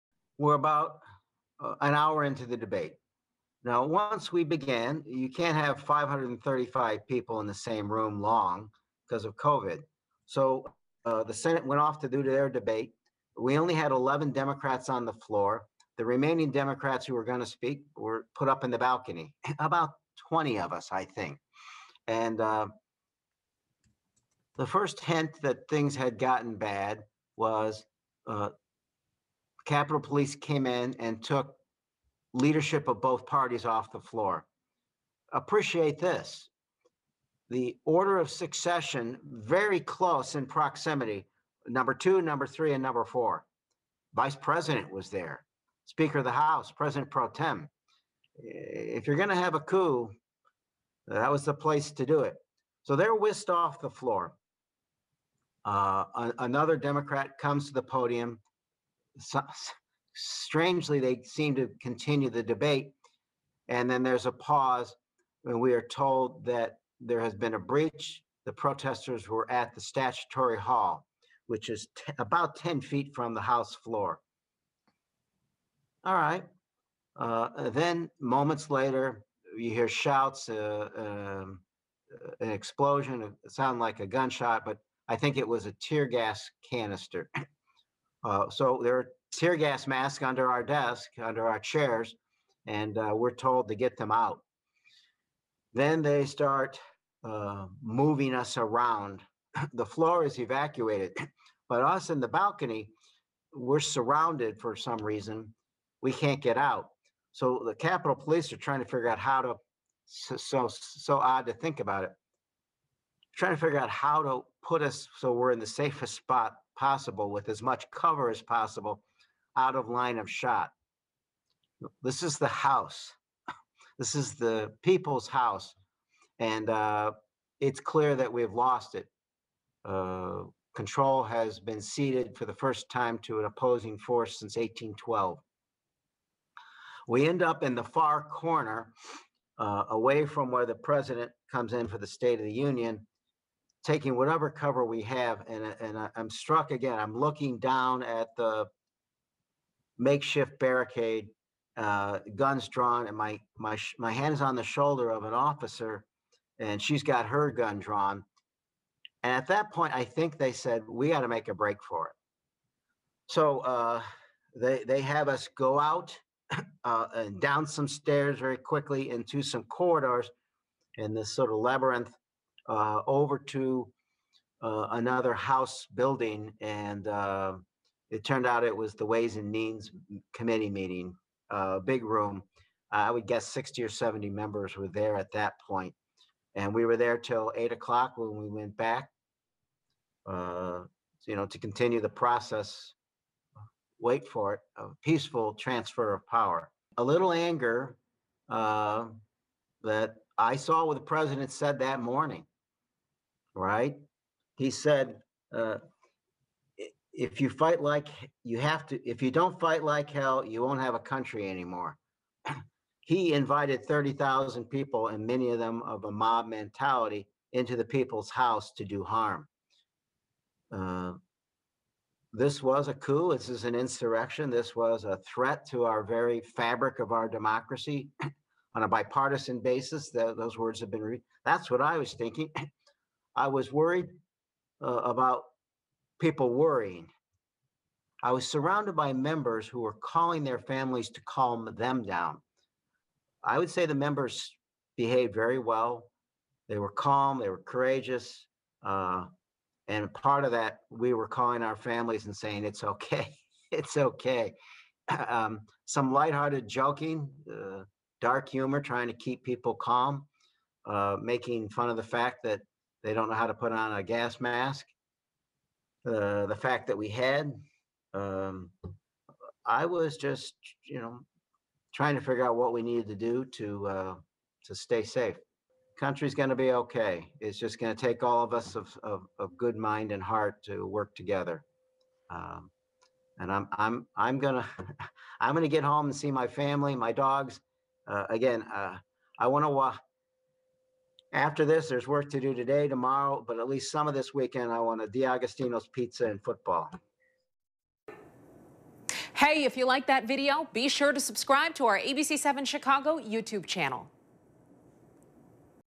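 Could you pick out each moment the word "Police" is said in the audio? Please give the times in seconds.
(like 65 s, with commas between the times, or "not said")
29 s, 108 s.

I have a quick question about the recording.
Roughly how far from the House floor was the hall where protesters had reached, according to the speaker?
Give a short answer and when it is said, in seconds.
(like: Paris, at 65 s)
10 feet, at 72 s.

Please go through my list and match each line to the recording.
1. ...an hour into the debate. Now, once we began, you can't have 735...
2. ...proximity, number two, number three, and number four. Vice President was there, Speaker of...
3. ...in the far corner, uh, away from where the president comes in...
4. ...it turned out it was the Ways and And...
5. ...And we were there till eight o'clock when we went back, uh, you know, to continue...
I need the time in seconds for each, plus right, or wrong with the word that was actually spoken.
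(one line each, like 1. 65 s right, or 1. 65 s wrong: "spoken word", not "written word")
1. 1 s wrong: "535", not "735"
2. 40 s right
3. 137 s right
4. 178 s wrong: "Means", not "And"
5. 186 s right.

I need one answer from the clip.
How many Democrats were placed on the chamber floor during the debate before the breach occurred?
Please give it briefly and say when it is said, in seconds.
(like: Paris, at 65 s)
11, at 13 s.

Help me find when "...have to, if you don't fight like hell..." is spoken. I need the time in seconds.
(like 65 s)
208 s.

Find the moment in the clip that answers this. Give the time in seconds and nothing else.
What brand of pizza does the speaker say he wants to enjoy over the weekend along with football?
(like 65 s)
295 s.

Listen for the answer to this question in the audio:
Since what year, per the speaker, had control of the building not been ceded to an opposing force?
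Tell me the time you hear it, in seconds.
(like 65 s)
134 s.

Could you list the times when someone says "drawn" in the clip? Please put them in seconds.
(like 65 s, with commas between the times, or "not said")
152 s, 157 s.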